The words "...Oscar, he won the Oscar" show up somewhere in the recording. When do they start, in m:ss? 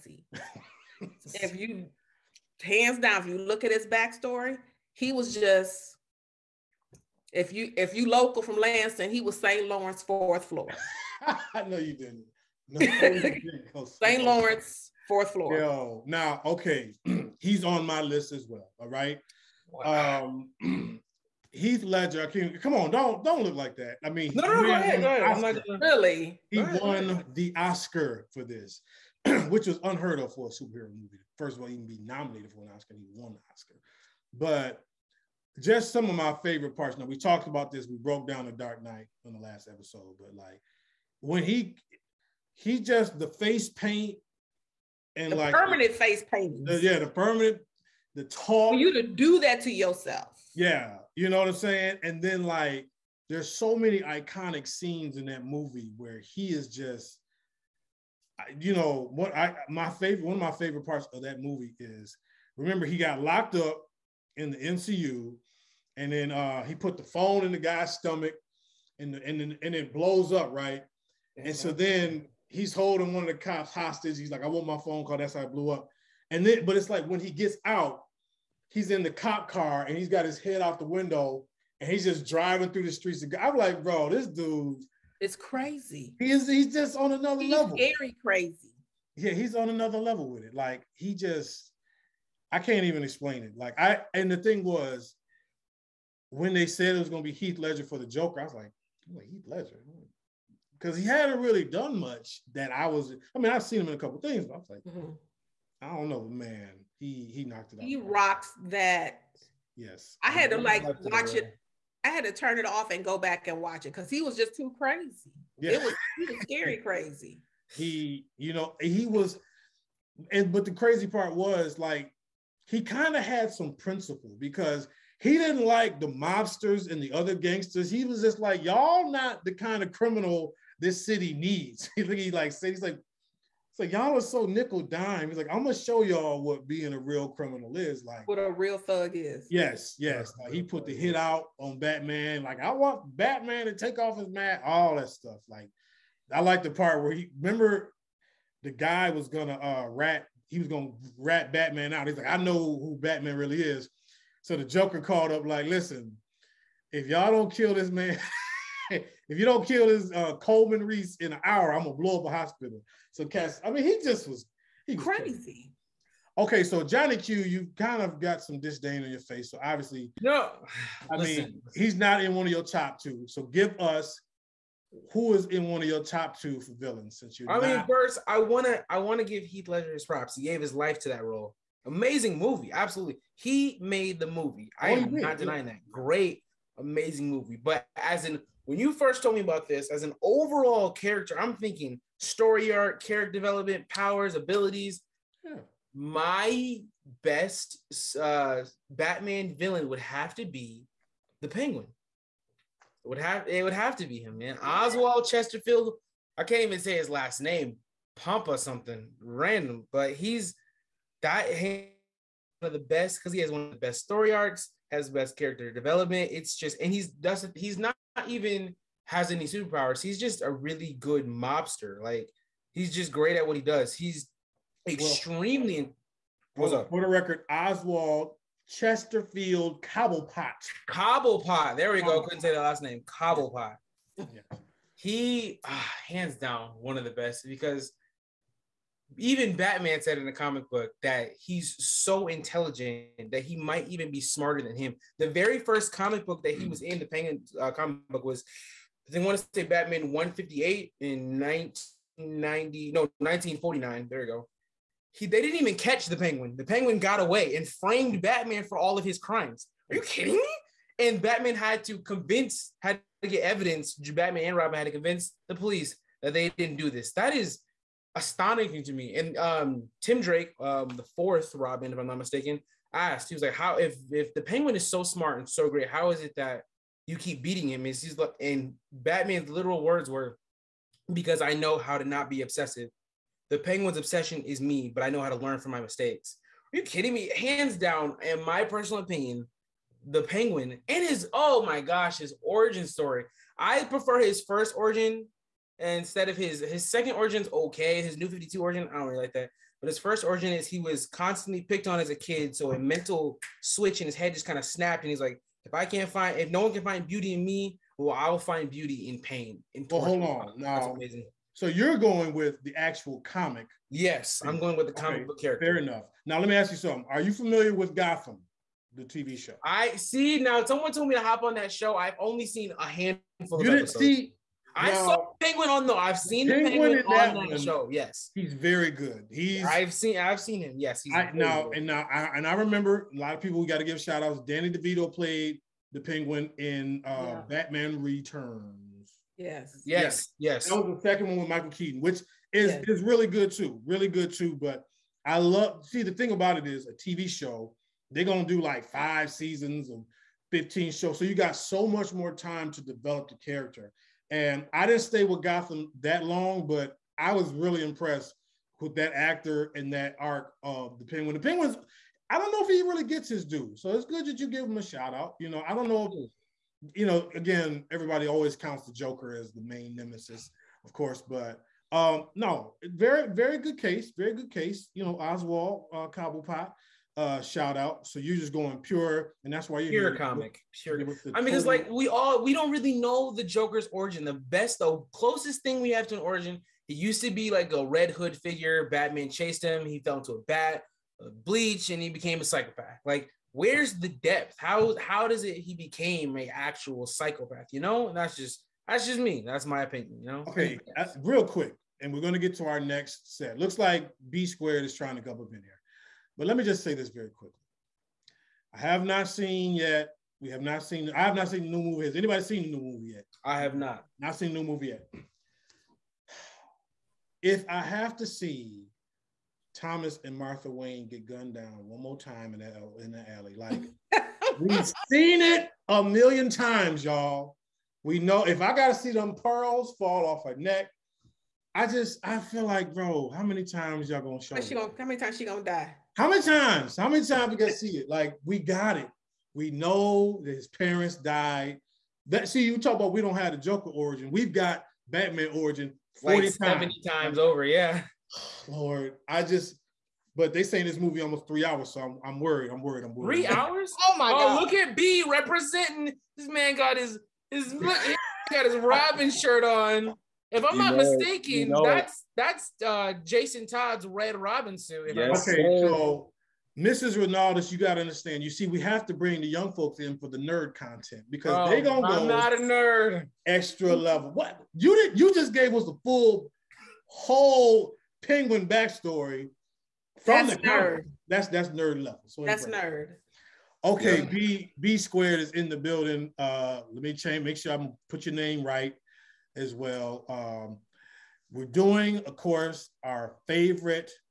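0:32.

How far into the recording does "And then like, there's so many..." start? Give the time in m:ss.
0:52.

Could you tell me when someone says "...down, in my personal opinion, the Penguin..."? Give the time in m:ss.
4:47.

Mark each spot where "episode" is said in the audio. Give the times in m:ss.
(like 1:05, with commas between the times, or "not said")
0:39, 5:23.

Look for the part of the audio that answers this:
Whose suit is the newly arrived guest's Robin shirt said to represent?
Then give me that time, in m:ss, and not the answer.
7:43.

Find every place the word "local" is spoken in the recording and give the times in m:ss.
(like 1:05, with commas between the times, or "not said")
0:08.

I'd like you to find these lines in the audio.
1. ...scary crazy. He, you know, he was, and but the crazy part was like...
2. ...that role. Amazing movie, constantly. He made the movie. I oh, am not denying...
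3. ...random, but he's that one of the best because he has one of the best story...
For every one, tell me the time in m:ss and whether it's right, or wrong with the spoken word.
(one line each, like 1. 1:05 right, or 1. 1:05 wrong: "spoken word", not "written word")
1. 1:56 right
2. 3:01 wrong: "absolutely", not "constantly"
3. 3:29 right.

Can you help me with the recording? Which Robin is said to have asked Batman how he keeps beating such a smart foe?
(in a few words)
Tim Drake.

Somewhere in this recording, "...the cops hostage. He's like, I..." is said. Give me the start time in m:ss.
1:13.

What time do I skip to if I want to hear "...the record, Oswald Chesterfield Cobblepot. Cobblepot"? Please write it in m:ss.
3:47.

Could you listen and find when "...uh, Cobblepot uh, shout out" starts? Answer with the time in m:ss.
6:15.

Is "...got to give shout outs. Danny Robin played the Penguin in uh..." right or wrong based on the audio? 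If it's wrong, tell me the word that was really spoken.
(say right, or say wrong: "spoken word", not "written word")
wrong: "DeVito", not "Robin".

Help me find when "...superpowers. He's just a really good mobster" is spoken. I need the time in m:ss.
3:39.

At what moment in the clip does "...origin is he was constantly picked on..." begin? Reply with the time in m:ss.
5:00.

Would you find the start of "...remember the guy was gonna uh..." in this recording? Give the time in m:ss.
2:27.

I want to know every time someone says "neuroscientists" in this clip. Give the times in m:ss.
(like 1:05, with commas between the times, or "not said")
not said.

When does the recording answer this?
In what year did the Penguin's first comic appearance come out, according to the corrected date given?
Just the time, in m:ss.
4:13.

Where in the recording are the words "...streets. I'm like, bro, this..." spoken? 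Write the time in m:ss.
1:22.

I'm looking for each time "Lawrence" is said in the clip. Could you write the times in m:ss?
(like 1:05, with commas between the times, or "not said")
0:09, 0:14.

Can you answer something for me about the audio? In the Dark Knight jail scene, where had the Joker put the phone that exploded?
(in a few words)
In the guy's stomach.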